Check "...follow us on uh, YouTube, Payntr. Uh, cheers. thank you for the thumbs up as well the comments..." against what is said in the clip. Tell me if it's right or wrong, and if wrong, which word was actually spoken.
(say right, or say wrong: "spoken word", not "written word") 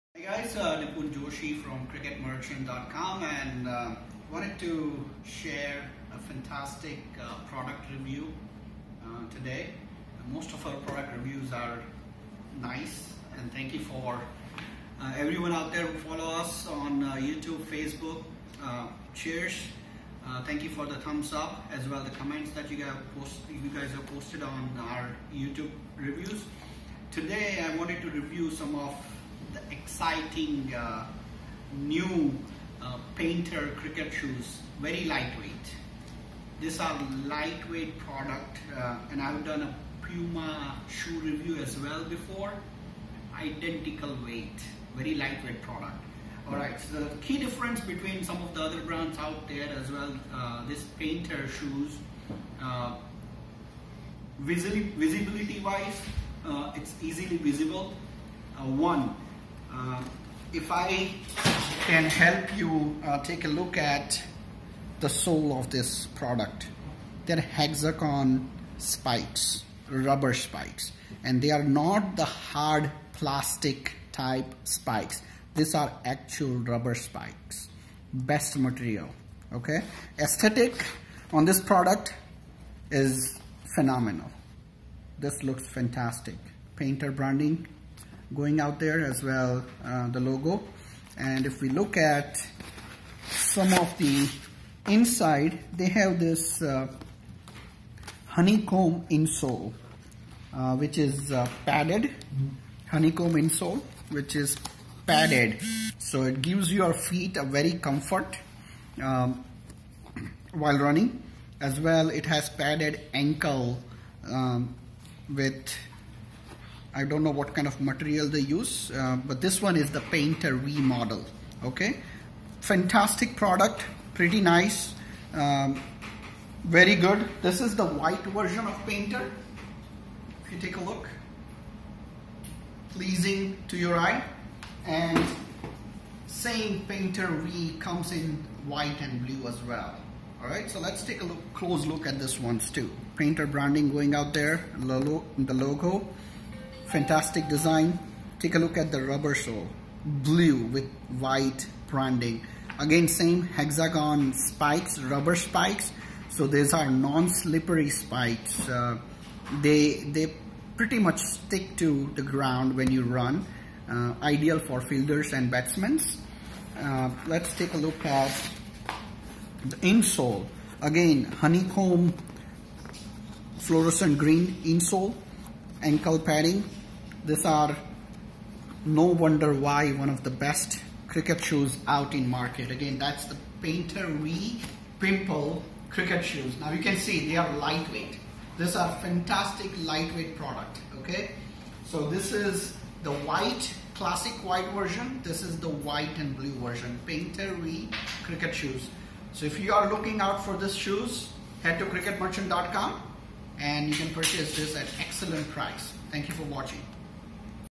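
wrong: "Facebook", not "Payntr".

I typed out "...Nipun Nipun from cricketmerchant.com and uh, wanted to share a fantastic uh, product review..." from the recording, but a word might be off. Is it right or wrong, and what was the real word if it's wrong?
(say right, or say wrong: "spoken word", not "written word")
wrong: "Joshi", not "Nipun".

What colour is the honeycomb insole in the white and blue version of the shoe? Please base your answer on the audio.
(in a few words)
fluorescent green.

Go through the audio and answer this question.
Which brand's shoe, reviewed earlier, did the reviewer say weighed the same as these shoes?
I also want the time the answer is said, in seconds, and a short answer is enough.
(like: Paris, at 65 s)
Puma, at 40 s.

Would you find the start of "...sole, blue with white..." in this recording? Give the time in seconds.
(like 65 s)
149 s.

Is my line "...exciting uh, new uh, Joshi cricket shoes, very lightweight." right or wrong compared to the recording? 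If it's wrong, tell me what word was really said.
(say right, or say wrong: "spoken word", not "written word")
wrong: "Payntr", not "Joshi".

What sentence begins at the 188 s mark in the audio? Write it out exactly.
These are fantastic lightweight product, okay?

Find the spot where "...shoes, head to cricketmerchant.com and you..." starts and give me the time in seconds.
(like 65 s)
200 s.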